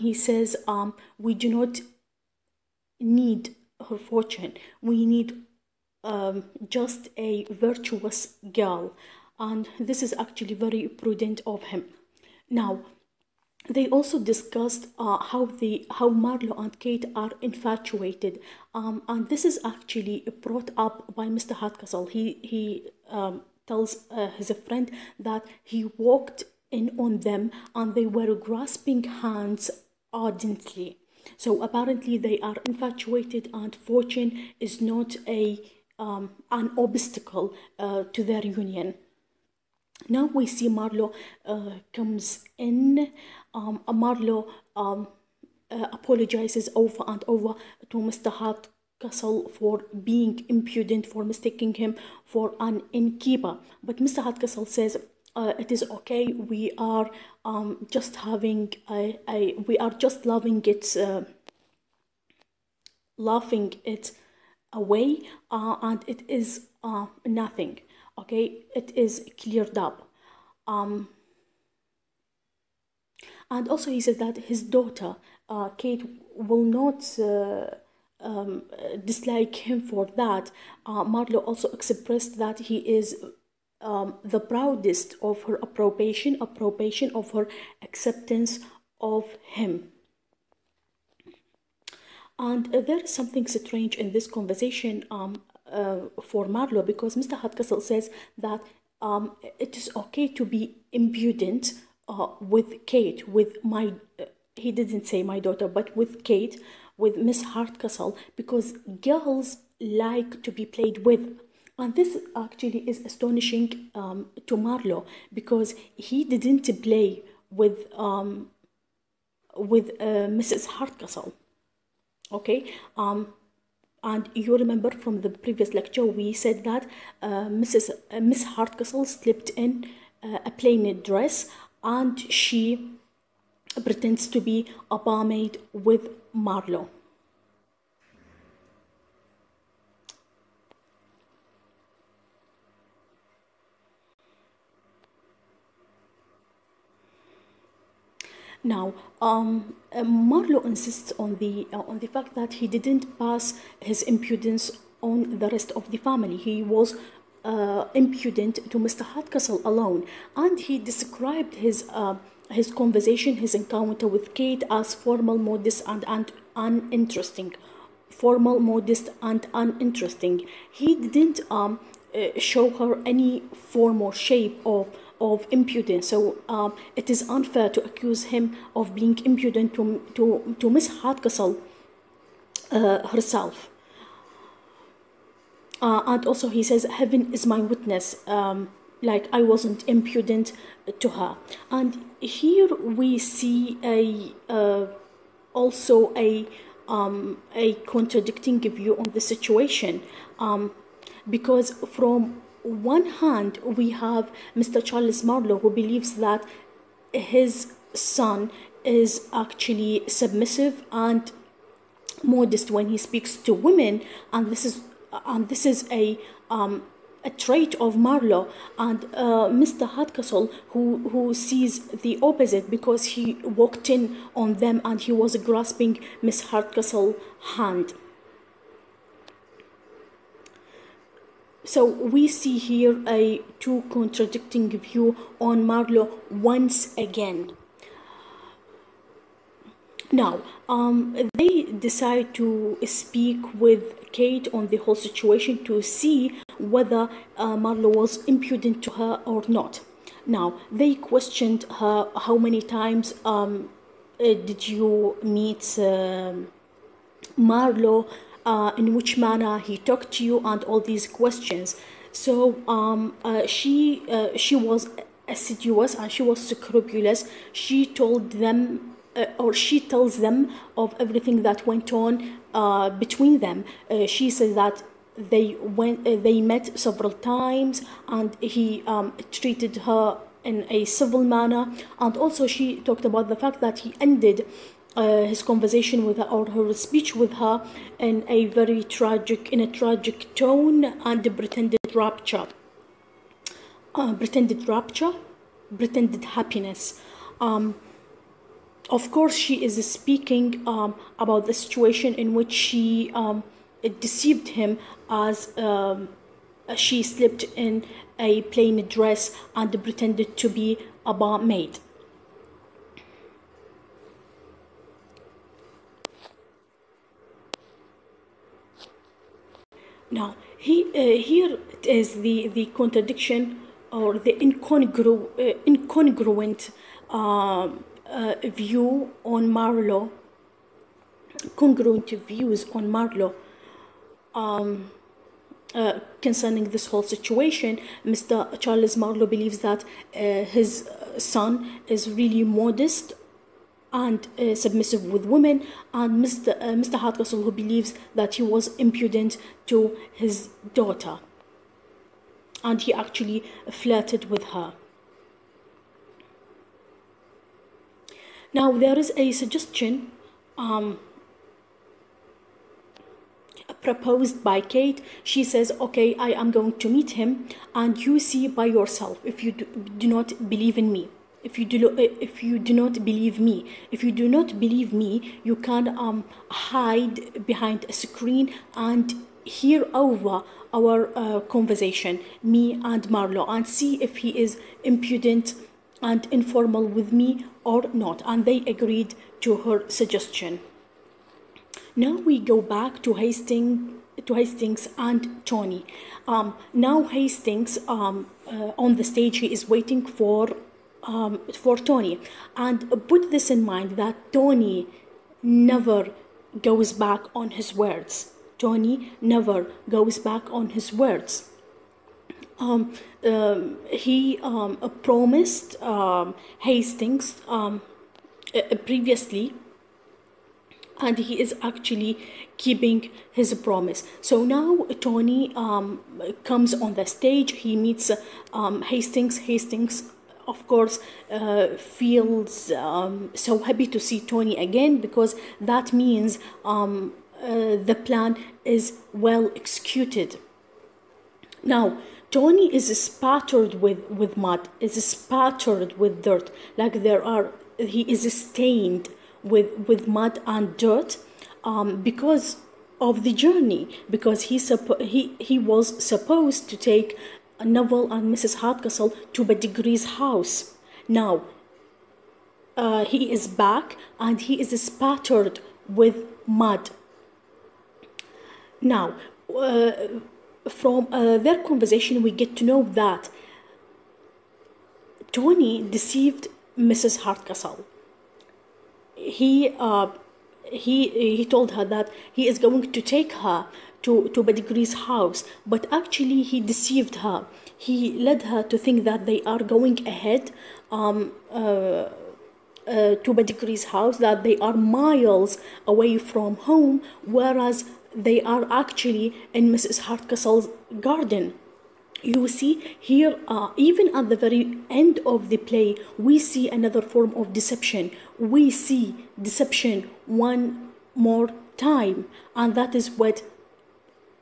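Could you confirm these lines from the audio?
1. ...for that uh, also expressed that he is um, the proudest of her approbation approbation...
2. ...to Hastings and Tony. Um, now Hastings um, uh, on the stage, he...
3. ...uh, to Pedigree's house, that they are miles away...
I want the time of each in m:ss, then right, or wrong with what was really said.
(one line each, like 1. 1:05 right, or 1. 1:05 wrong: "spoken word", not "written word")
1. 1:19 right
2. 6:34 right
3. 8:12 right.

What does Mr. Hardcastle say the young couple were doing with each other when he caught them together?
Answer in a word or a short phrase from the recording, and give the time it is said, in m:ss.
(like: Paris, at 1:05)
Grasping hands, at 0:28.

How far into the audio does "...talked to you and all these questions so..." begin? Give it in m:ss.
4:19.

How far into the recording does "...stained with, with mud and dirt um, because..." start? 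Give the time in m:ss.
7:28.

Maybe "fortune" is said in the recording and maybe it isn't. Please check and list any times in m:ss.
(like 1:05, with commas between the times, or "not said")
0:03, 0:33.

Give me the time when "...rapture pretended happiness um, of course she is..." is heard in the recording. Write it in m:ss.
4:54.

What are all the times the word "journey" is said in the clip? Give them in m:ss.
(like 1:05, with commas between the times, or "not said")
7:33.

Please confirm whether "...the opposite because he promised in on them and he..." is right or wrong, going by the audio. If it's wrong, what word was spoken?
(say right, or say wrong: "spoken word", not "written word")
wrong: "walked", not "promised".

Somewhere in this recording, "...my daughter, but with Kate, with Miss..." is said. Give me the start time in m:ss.
1:45.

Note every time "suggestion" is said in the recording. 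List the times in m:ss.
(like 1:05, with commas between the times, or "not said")
5:59, 6:30.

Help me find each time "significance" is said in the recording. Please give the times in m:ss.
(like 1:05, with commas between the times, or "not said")
not said.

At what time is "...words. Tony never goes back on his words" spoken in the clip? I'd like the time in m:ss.
6:47.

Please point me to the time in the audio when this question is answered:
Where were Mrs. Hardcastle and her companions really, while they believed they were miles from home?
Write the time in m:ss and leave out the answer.
8:19.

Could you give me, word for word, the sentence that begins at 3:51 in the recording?
So we see here a two contradicting view on Marlowe once again.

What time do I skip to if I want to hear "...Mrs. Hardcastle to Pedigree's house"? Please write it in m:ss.
7:38.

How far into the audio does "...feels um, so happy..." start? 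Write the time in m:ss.
7:11.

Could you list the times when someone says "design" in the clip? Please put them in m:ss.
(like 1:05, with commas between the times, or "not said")
not said.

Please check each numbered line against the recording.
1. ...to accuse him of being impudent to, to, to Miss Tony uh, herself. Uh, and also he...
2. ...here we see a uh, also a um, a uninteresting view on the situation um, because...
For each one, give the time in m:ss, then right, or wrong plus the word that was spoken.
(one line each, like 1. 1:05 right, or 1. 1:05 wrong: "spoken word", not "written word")
1. 2:57 wrong: "Hardcastle", not "Tony"
2. 3:12 wrong: "contradicting", not "uninteresting".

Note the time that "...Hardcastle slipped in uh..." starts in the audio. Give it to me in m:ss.
2:08.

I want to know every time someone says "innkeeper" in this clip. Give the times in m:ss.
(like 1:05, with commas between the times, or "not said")
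0:52.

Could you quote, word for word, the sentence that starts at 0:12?
Now, they also discussed uh, how the how Marlow and Kate are infatuated, um, and this is actually brought up by Mr.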